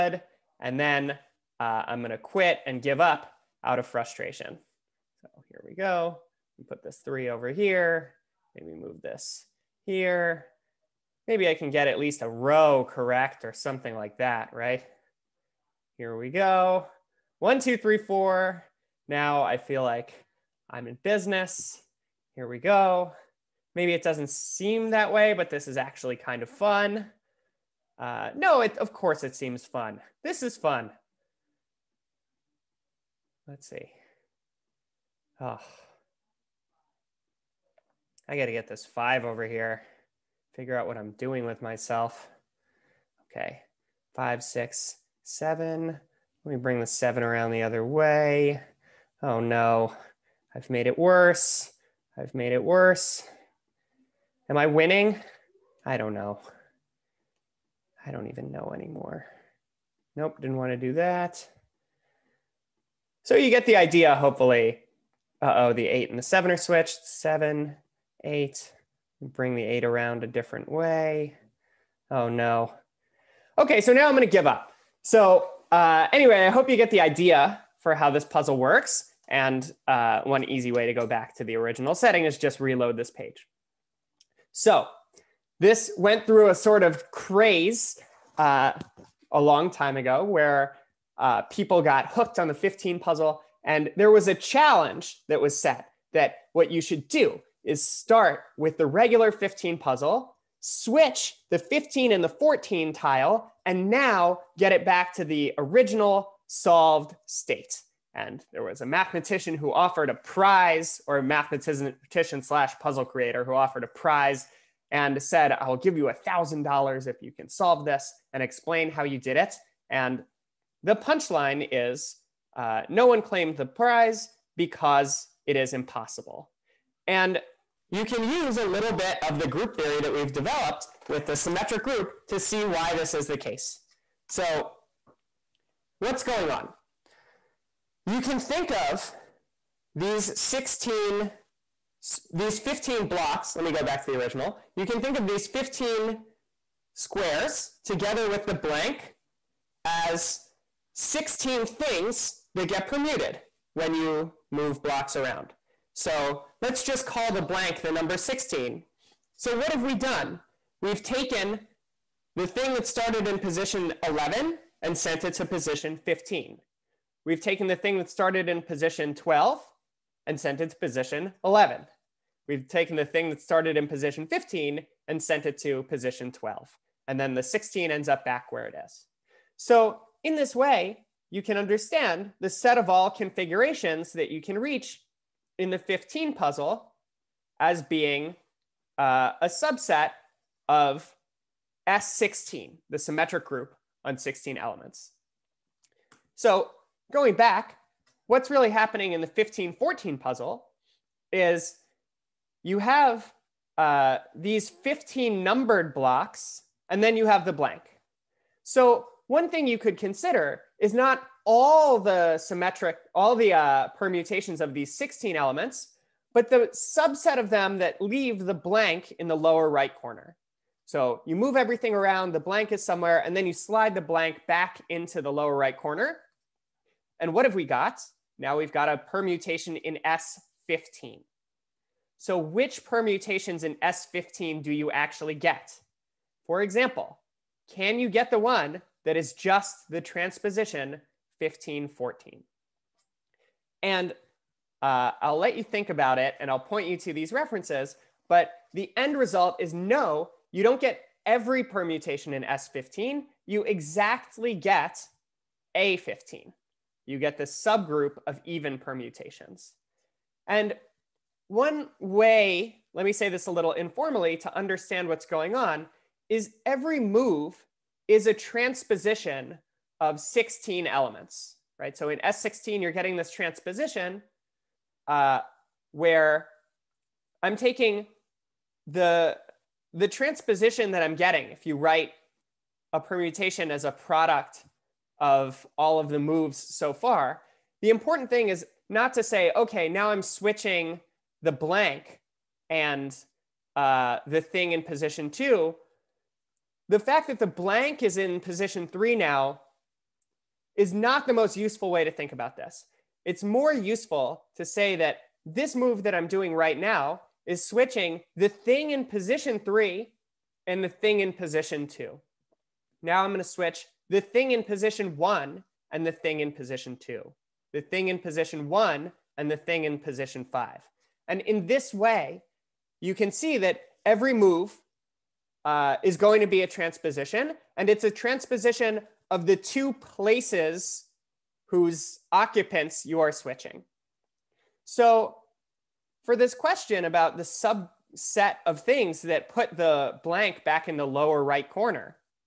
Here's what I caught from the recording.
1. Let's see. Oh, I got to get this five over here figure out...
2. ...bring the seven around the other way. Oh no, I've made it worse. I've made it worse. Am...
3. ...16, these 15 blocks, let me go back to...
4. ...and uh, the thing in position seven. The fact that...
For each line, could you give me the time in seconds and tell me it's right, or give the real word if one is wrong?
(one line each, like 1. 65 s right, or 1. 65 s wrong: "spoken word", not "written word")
1. 33 s right
2. 46 s right
3. 140 s right
4. 292 s wrong: "two", not "seven".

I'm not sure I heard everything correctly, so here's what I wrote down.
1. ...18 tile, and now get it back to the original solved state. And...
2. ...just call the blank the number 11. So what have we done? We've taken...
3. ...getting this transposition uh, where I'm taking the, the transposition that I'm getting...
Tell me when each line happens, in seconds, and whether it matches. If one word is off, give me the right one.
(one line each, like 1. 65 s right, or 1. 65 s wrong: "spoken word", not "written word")
1. 102 s wrong: "14", not "18"
2. 156 s wrong: "16", not "11"
3. 272 s right.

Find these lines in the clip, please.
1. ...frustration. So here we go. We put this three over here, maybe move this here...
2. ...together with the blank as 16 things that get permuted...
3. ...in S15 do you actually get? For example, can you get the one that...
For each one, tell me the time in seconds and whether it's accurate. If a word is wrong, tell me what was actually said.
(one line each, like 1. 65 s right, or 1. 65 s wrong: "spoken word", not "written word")
1. 3 s right
2. 147 s right
3. 233 s right.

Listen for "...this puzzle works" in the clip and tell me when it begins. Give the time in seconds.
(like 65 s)
78 s.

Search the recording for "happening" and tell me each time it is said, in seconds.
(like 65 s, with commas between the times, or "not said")
198 s.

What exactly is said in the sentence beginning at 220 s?
So you move everything around, the blank is somewhere, and then you slide the blank back into the lower right corner.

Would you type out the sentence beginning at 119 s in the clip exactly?
And the punchline is uh, no one claimed the prize because it is impossible.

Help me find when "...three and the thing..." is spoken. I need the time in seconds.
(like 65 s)
309 s.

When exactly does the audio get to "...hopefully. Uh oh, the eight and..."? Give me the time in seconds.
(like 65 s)
64 s.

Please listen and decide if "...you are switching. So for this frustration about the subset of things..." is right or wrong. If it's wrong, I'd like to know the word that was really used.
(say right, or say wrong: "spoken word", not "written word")
wrong: "question", not "frustration".